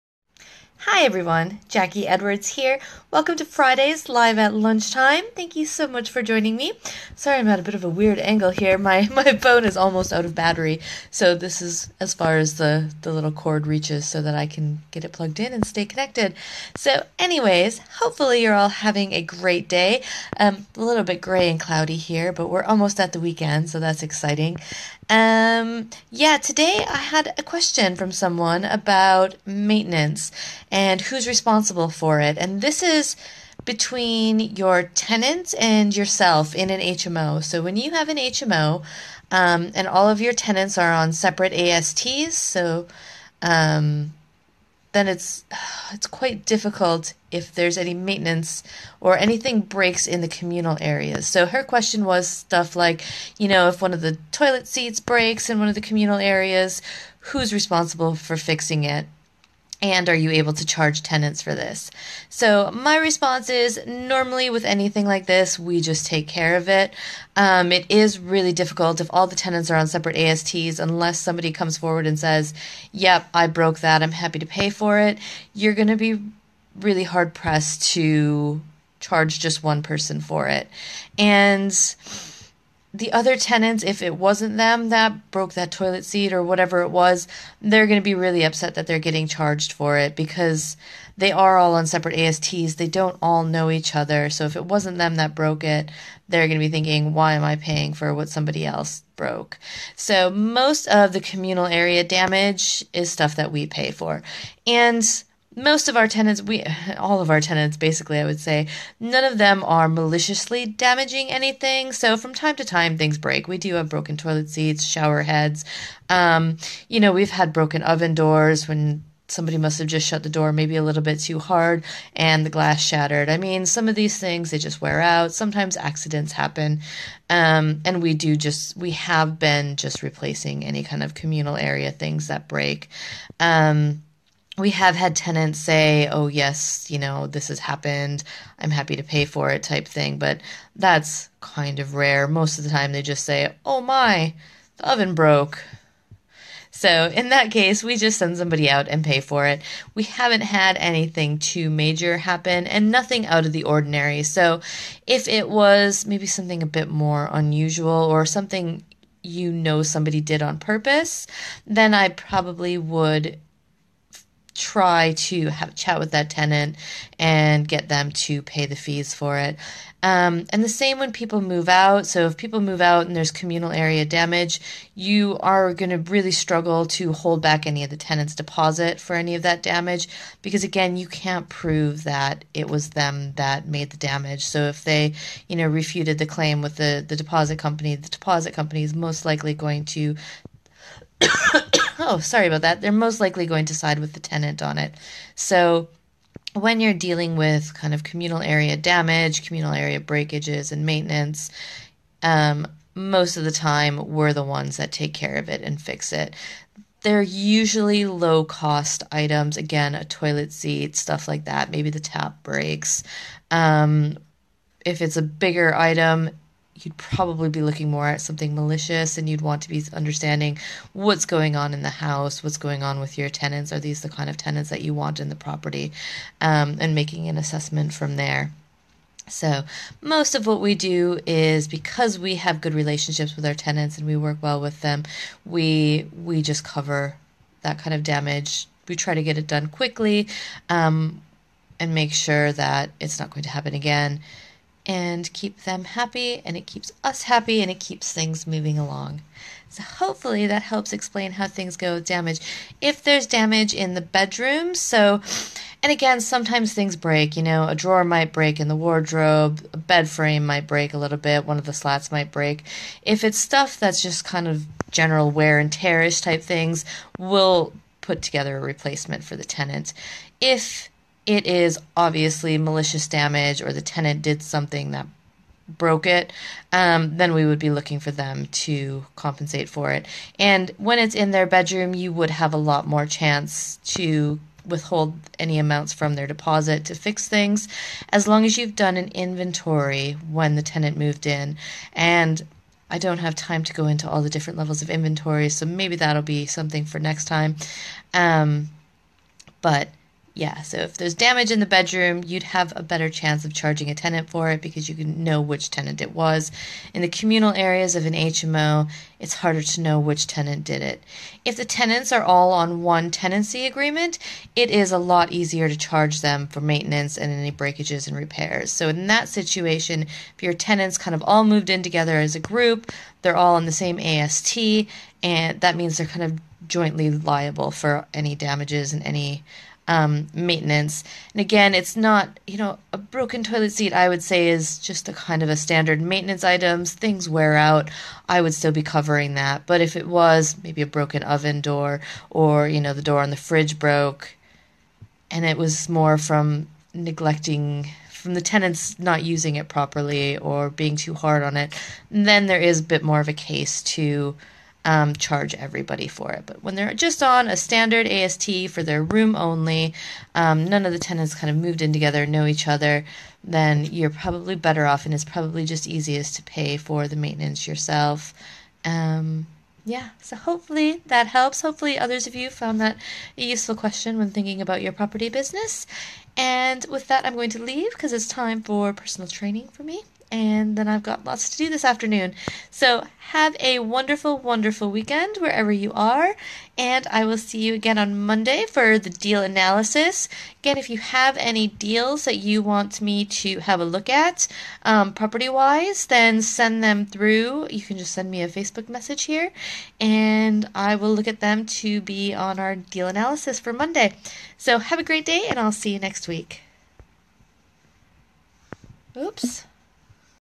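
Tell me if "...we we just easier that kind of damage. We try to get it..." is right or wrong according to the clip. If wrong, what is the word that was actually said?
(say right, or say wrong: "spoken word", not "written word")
wrong: "cover", not "easier".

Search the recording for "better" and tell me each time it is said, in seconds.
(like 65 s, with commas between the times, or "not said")
302 s, 364 s.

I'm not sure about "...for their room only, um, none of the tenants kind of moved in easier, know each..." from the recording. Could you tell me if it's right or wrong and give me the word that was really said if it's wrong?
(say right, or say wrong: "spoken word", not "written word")
wrong: "together", not "easier".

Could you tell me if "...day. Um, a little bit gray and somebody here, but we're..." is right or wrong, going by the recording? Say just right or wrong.
wrong.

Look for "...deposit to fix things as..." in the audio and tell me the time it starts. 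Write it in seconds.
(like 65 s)
286 s.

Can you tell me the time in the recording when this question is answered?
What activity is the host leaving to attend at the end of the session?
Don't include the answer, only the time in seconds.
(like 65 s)
378 s.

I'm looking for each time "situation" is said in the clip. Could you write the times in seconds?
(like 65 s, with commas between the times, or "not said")
319 s.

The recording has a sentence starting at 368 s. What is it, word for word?
Um, yeah, so hopefully that helps.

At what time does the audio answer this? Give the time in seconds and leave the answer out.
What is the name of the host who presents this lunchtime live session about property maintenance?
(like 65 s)
1 s.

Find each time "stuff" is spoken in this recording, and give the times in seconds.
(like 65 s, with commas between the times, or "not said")
52 s, 103 s, 210 s, 263 s.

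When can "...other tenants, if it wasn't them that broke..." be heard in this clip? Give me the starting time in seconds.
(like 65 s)
83 s.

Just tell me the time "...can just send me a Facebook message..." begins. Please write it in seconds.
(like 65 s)
397 s.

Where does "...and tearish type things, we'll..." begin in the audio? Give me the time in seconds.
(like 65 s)
265 s.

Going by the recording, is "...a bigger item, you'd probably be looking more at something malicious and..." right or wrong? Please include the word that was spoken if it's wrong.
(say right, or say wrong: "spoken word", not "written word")
right.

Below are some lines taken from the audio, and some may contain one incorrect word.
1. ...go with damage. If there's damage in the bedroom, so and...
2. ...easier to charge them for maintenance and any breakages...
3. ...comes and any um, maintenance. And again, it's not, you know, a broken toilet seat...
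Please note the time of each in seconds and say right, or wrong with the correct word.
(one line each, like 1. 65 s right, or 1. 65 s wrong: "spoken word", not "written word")
1. 251 s right
2. 315 s right
3. 328 s wrong: "damages", not "comes".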